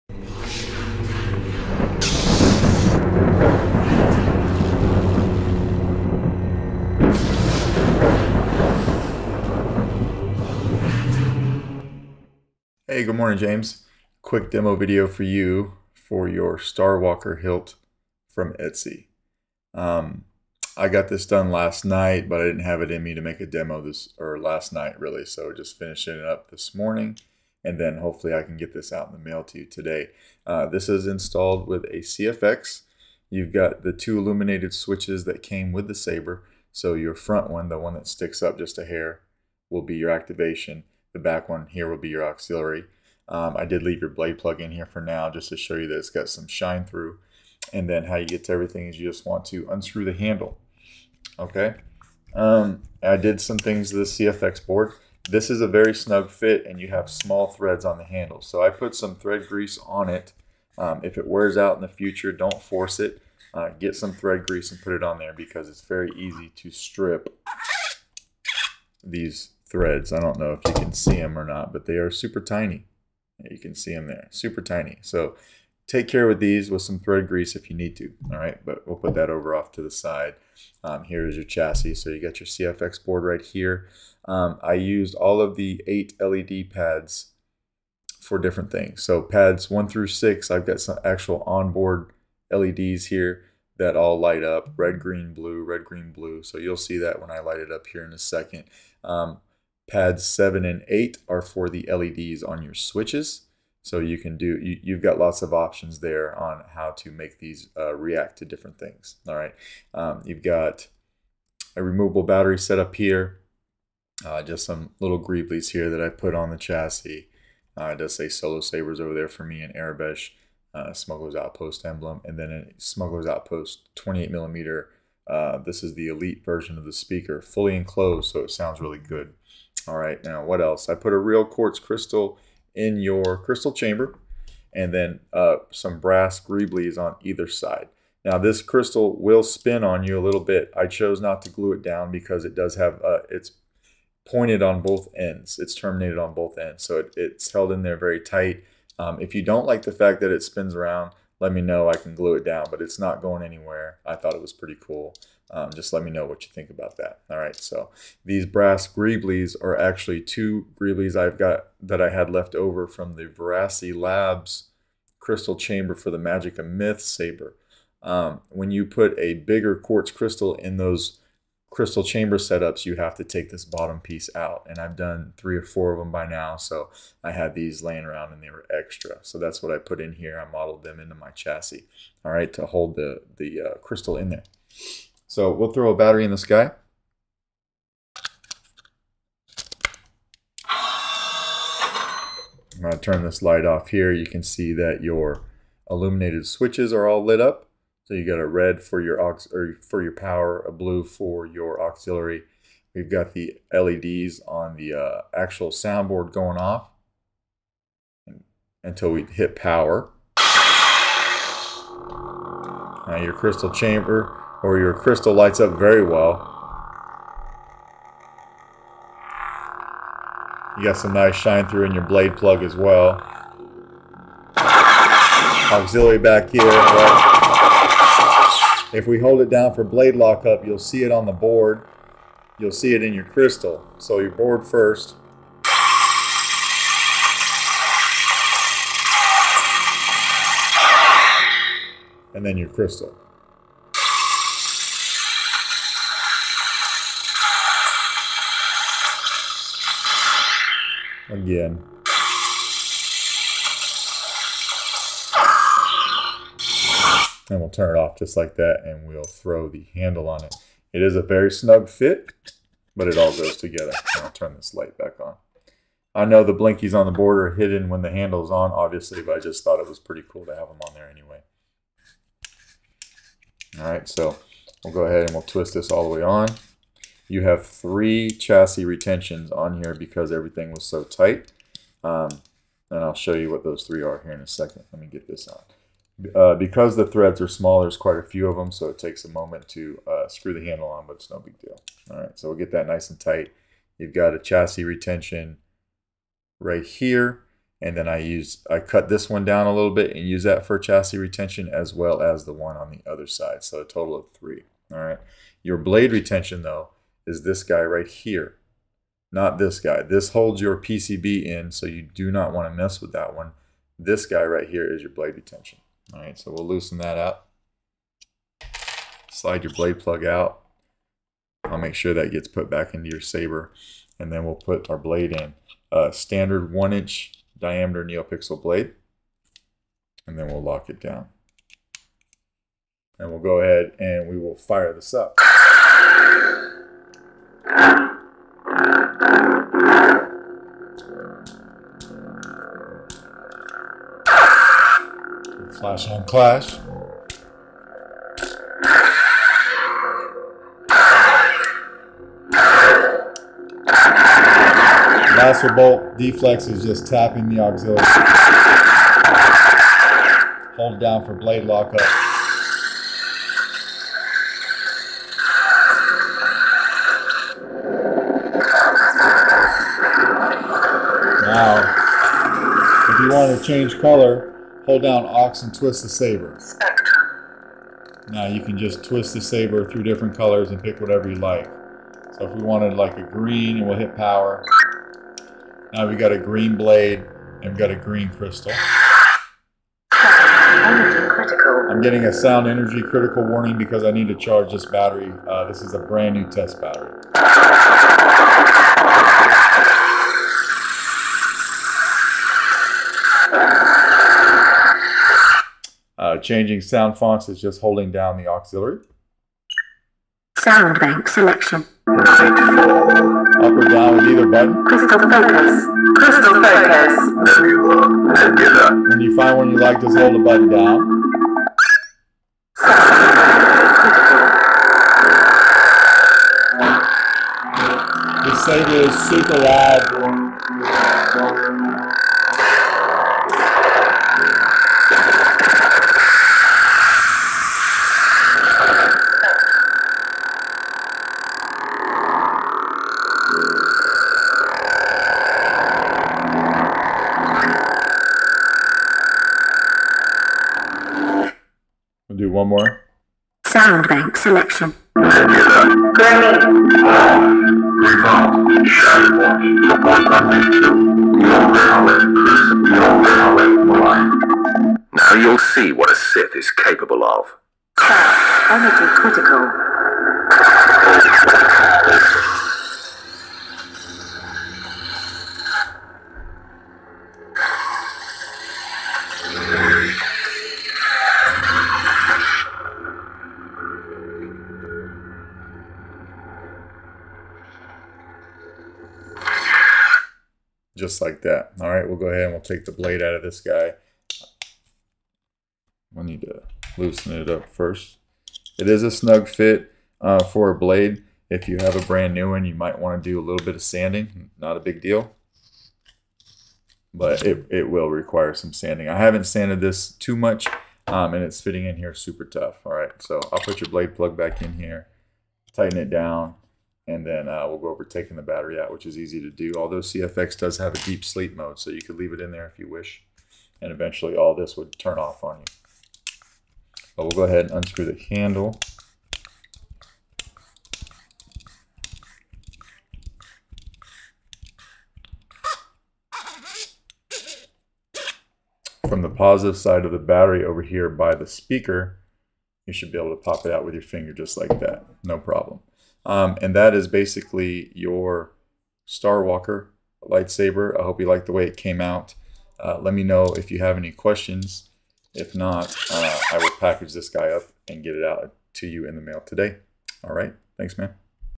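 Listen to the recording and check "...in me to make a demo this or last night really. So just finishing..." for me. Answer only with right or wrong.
right.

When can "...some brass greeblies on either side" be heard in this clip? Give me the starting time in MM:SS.
02:15.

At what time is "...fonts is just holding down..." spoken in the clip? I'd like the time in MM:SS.
06:47.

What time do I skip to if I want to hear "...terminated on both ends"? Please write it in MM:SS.
02:25.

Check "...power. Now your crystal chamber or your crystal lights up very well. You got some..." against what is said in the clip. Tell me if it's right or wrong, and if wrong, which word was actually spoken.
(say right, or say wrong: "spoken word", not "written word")
right.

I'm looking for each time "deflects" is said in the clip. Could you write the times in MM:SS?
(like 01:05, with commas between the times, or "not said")
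05:56.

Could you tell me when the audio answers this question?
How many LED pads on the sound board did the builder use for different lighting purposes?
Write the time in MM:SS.
01:25.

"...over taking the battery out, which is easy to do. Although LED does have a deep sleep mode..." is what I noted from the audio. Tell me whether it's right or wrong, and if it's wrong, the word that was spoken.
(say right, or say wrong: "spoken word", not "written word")
wrong: "CFX", not "LED".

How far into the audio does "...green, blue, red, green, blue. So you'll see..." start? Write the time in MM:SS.
01:34.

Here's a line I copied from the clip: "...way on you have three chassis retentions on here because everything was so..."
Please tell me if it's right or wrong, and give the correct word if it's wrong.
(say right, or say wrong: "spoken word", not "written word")
right.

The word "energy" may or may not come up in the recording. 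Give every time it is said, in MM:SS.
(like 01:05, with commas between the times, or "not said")
06:32, 07:48.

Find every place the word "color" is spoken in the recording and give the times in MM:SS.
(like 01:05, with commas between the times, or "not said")
06:13, 06:20.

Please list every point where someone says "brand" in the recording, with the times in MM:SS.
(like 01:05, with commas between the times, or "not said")
06:35, 08:22.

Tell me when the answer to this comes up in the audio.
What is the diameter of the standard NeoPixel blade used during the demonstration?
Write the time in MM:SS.
05:26.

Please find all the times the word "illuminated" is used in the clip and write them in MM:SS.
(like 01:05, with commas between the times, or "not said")
00:34, 03:15.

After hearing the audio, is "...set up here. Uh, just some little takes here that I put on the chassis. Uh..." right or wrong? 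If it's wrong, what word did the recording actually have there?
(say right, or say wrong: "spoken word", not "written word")
wrong: "greeblies", not "takes".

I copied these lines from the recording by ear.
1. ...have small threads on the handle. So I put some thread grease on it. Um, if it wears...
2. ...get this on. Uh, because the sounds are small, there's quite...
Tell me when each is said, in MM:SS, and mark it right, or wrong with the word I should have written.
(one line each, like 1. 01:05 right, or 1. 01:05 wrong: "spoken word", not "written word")
1. 00:56 right
2. 04:45 wrong: "threads", not "sounds".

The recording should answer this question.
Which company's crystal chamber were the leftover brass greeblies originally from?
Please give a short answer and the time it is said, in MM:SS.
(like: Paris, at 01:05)
Veracity Labs, at 02:43.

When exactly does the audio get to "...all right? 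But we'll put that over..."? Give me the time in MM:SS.
01:18.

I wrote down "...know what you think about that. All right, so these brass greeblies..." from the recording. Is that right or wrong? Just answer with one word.
right.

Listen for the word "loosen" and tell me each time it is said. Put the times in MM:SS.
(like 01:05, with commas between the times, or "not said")
05:16, 08:16.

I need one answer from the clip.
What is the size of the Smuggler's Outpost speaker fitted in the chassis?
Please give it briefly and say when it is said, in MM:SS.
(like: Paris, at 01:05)
28 millimeter, at 02:03.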